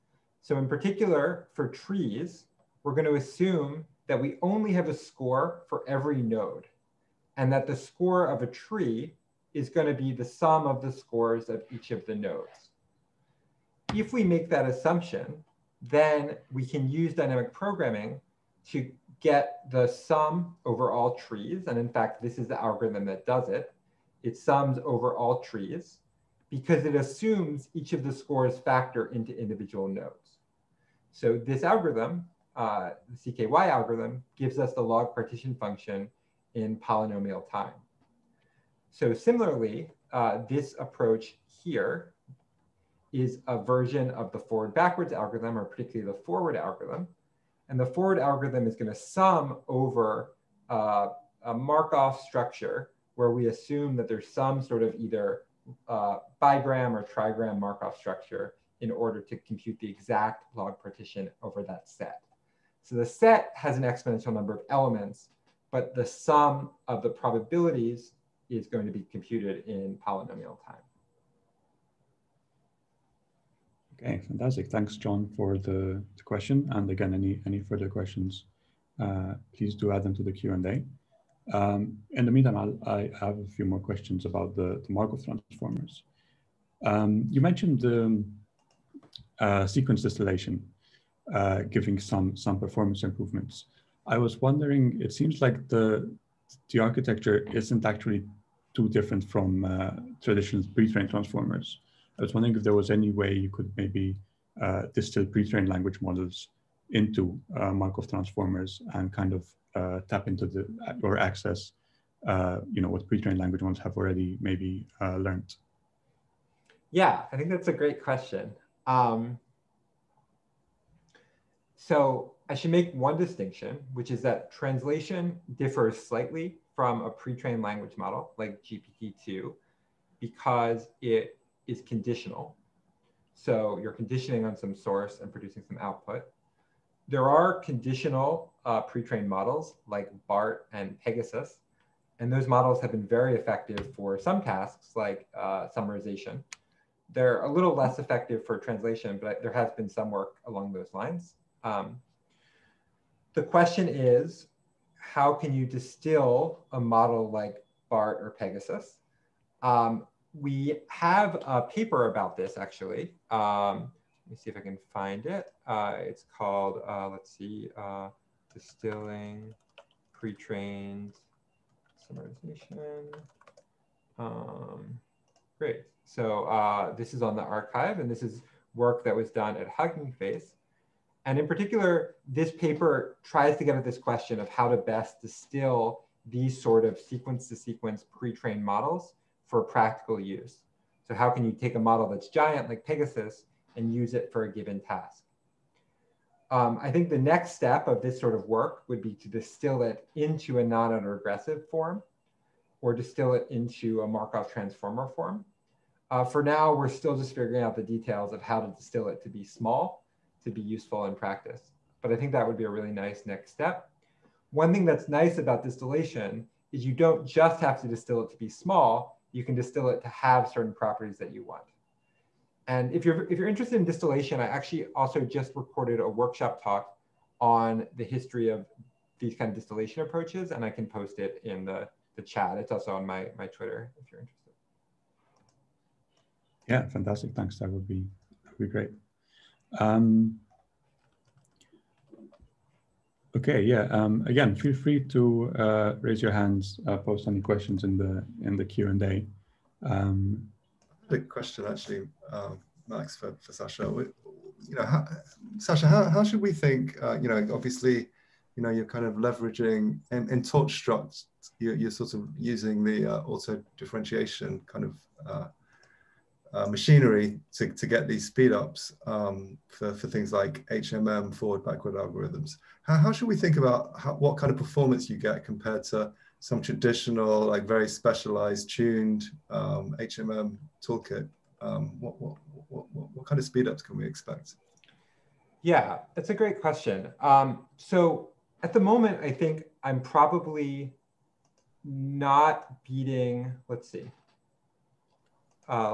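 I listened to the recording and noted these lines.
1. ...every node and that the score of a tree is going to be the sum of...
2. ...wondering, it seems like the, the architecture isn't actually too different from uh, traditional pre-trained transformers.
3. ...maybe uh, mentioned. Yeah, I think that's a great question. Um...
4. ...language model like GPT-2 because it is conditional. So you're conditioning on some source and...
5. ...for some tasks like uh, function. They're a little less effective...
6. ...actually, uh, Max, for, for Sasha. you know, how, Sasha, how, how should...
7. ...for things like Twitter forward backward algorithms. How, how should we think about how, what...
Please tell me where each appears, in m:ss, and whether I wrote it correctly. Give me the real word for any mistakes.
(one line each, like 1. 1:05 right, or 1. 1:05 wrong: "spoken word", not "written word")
1. 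0:05 right
2. 1:34 right
3. 1:54 wrong: "learned", not "mentioned"
4. 2:07 right
5. 2:23 wrong: "summarization", not "function"
6. 4:11 right
7. 4:29 wrong: "HMM", not "Twitter".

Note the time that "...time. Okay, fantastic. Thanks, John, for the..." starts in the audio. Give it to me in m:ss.
1:10.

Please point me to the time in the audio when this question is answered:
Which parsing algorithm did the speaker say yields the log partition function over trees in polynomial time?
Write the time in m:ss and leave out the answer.
0:33.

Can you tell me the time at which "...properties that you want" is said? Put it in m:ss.
3:40.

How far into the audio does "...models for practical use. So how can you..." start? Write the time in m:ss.
3:08.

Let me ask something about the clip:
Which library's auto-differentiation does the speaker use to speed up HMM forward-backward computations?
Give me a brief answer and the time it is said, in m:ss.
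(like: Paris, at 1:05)
torch struct, at 4:20.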